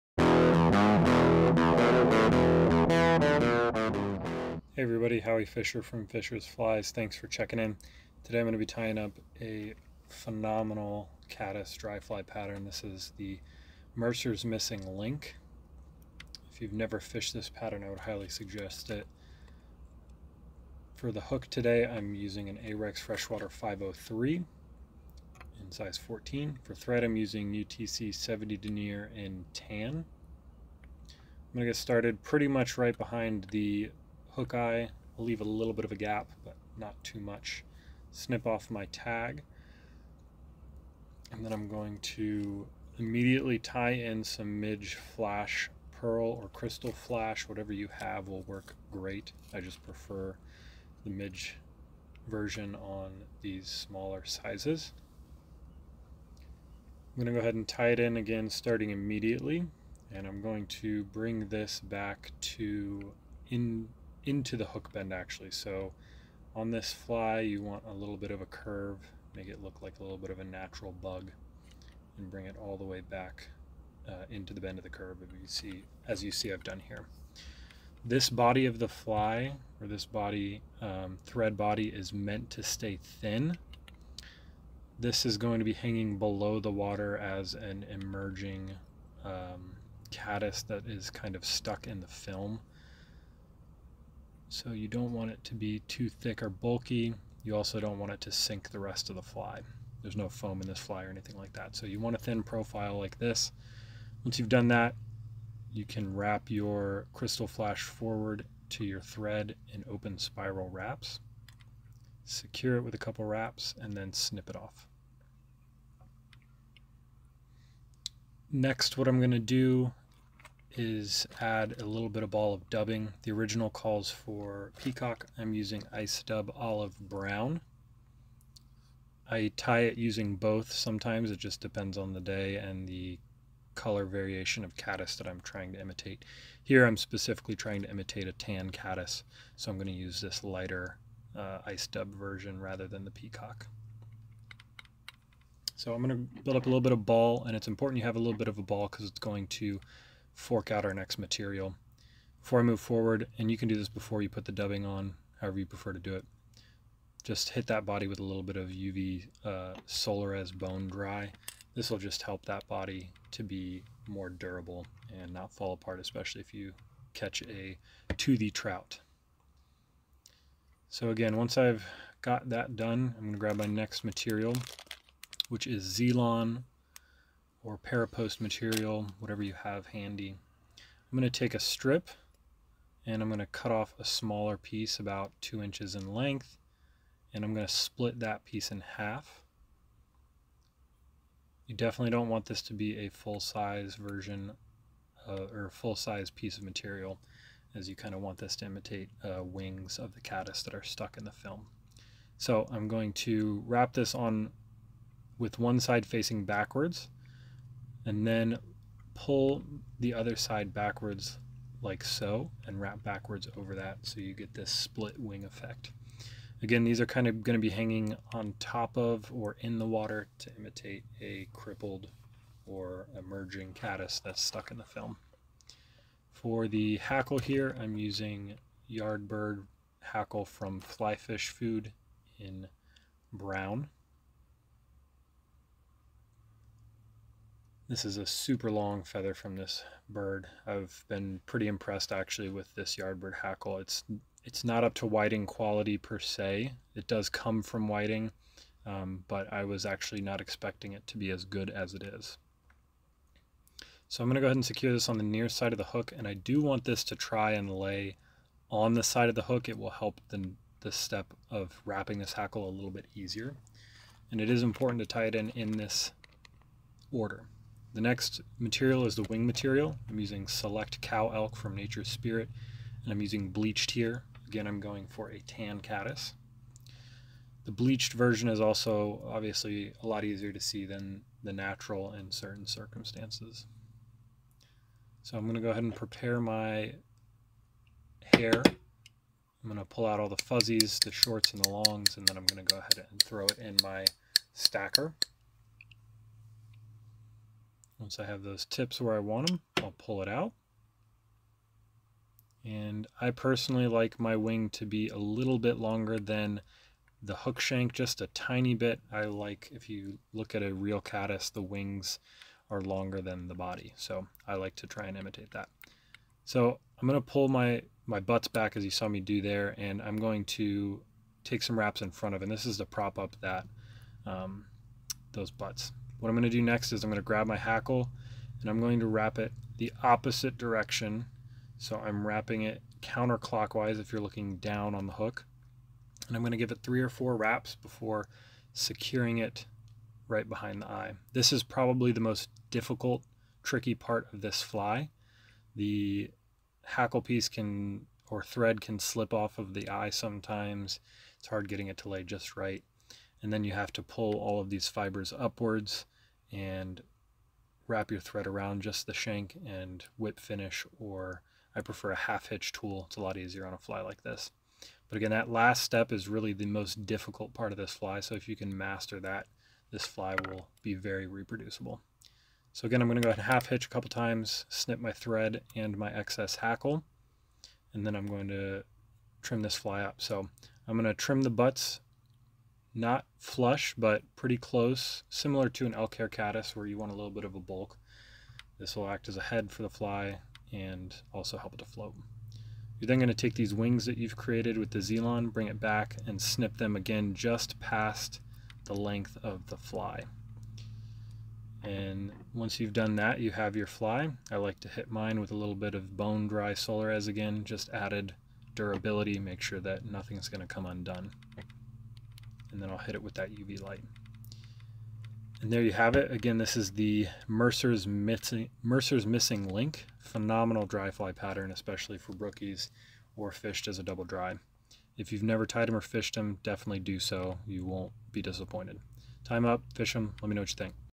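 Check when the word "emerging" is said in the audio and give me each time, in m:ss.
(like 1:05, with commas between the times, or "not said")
1:27, 3:43.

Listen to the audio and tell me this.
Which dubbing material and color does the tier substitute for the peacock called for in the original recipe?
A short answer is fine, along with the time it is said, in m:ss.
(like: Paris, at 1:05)
Ice dub olive brown, at 2:05.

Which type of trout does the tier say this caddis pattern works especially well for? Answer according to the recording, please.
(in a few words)
Brookies.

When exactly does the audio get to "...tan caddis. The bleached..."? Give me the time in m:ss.
4:35.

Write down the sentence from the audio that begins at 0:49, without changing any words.
I just prefer the midge version on these smaller sizes.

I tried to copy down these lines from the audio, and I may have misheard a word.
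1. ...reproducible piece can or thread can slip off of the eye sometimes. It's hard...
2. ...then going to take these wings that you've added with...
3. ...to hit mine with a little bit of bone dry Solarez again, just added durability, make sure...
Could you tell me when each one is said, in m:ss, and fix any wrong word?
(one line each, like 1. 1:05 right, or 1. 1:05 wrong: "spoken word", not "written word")
1. 5:46 wrong: "hackle", not "reproducible"
2. 6:33 wrong: "created", not "added"
3. 6:44 right.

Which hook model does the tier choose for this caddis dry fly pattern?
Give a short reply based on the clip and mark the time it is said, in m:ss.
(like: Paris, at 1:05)
Ahrex Freshwater 503, at 0:22.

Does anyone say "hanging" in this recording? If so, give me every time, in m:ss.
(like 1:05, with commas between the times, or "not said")
1:25, 3:37.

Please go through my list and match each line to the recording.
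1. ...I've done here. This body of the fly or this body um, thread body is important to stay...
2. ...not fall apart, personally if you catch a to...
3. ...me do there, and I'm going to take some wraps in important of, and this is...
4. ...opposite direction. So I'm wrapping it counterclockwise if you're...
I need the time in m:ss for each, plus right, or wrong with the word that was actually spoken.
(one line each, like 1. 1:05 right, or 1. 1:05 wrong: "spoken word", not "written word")
1. 1:16 wrong: "meant", not "important"
2. 2:45 wrong: "especially", not "personally"
3. 5:19 wrong: "front", not "important"
4. 5:30 right.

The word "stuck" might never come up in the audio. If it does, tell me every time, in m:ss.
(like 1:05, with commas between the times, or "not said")
1:31, 3:20, 3:44.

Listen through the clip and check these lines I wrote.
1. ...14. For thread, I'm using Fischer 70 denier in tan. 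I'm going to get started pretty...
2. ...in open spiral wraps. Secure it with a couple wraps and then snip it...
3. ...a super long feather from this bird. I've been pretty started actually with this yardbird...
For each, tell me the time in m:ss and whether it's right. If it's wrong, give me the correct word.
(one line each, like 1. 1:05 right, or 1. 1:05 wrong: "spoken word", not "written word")
1. 0:25 wrong: "UTC", not "Fischer"
2. 1:49 right
3. 3:58 wrong: "impressed", not "started".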